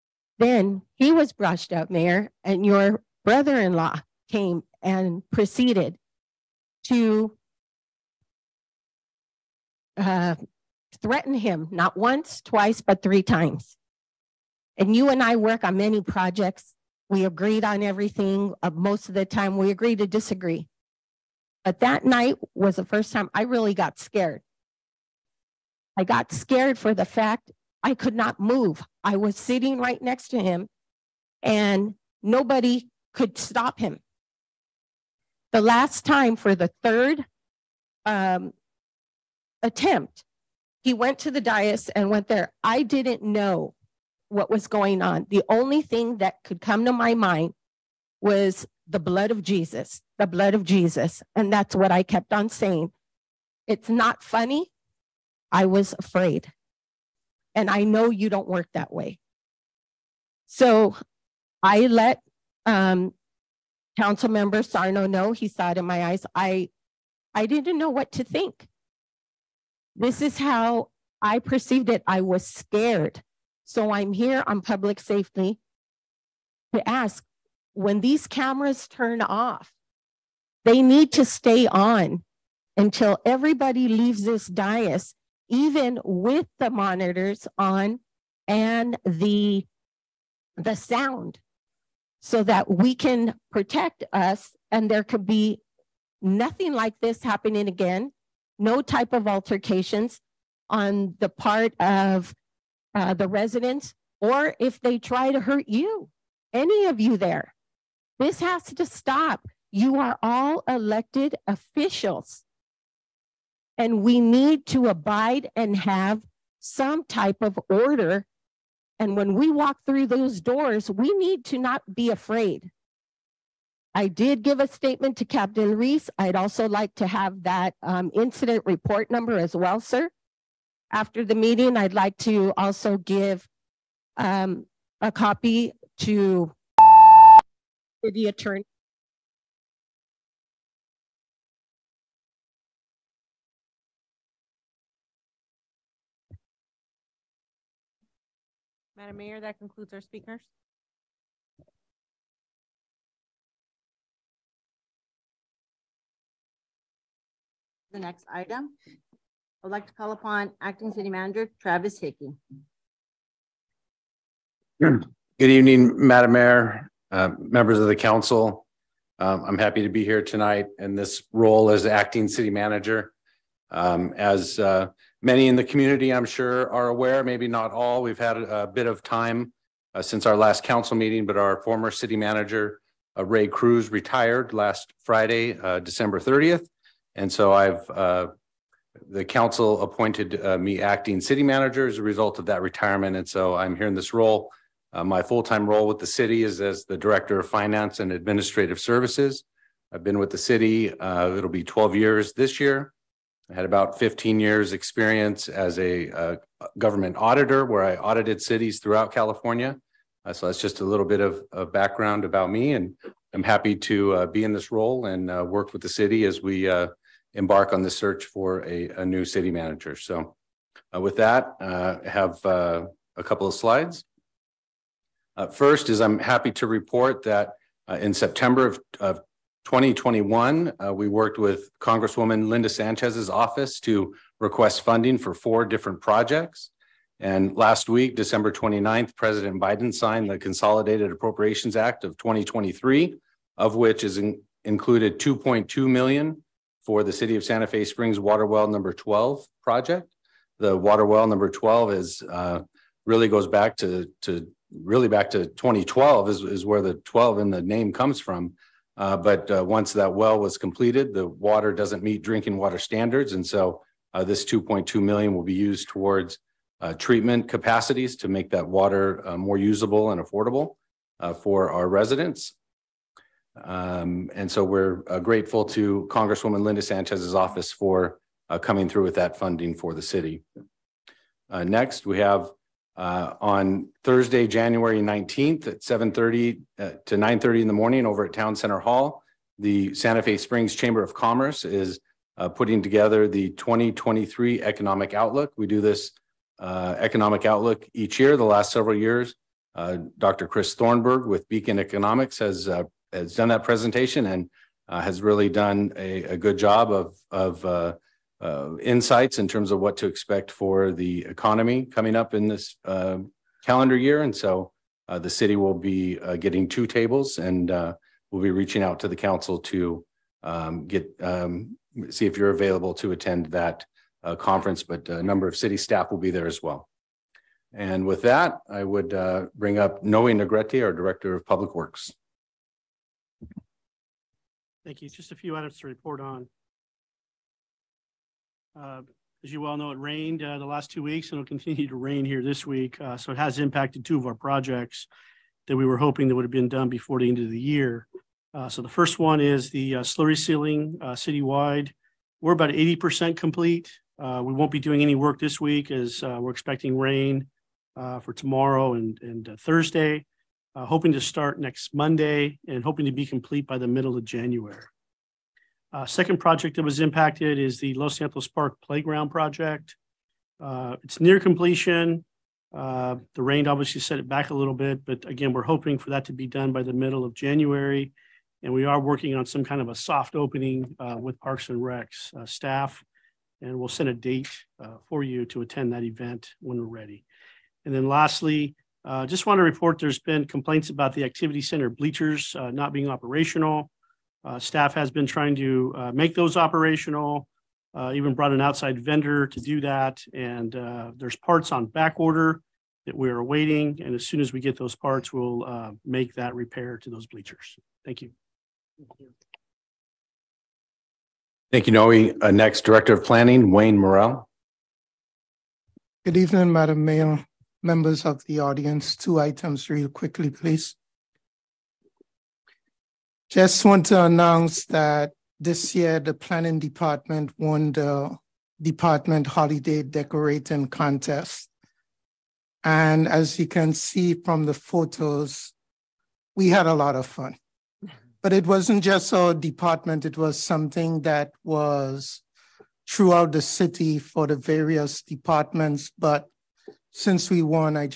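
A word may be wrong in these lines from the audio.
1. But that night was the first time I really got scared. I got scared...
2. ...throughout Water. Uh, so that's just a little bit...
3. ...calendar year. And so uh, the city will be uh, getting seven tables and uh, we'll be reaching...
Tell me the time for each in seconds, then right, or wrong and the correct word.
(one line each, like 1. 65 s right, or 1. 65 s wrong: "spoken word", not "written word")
1. 21 s right
2. 208 s wrong: "California", not "Water"
3. 313 s wrong: "two", not "seven".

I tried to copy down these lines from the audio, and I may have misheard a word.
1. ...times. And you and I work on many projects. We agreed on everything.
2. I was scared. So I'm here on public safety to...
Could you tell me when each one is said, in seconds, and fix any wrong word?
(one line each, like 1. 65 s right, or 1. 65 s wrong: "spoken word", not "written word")
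1. 13 s right
2. 72 s right.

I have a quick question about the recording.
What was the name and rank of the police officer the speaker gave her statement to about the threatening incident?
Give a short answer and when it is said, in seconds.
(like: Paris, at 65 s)
Captain Reese, at 125 s.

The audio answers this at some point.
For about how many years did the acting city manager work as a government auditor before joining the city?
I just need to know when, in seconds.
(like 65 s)
203 s.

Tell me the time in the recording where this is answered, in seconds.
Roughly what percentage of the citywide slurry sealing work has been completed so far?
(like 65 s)
352 s.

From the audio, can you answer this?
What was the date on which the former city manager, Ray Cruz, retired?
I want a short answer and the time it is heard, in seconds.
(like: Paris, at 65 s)
December 30th, at 185 s.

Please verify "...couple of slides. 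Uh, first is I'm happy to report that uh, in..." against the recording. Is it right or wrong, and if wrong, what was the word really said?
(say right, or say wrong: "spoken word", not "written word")
right.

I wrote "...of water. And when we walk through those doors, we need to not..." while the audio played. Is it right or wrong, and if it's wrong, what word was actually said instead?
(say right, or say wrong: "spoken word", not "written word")
wrong: "order", not "water".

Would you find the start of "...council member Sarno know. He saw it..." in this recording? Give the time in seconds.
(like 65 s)
63 s.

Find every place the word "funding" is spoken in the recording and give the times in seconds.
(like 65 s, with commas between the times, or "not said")
234 s, 279 s.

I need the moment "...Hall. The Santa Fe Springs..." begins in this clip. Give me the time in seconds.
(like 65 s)
288 s.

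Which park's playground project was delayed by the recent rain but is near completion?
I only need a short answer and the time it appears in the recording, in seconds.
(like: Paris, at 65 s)
Los Nietos Park, at 367 s.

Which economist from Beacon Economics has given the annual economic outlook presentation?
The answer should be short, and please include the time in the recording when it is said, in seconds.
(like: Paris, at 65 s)
Dr. Chris Thornberg, at 300 s.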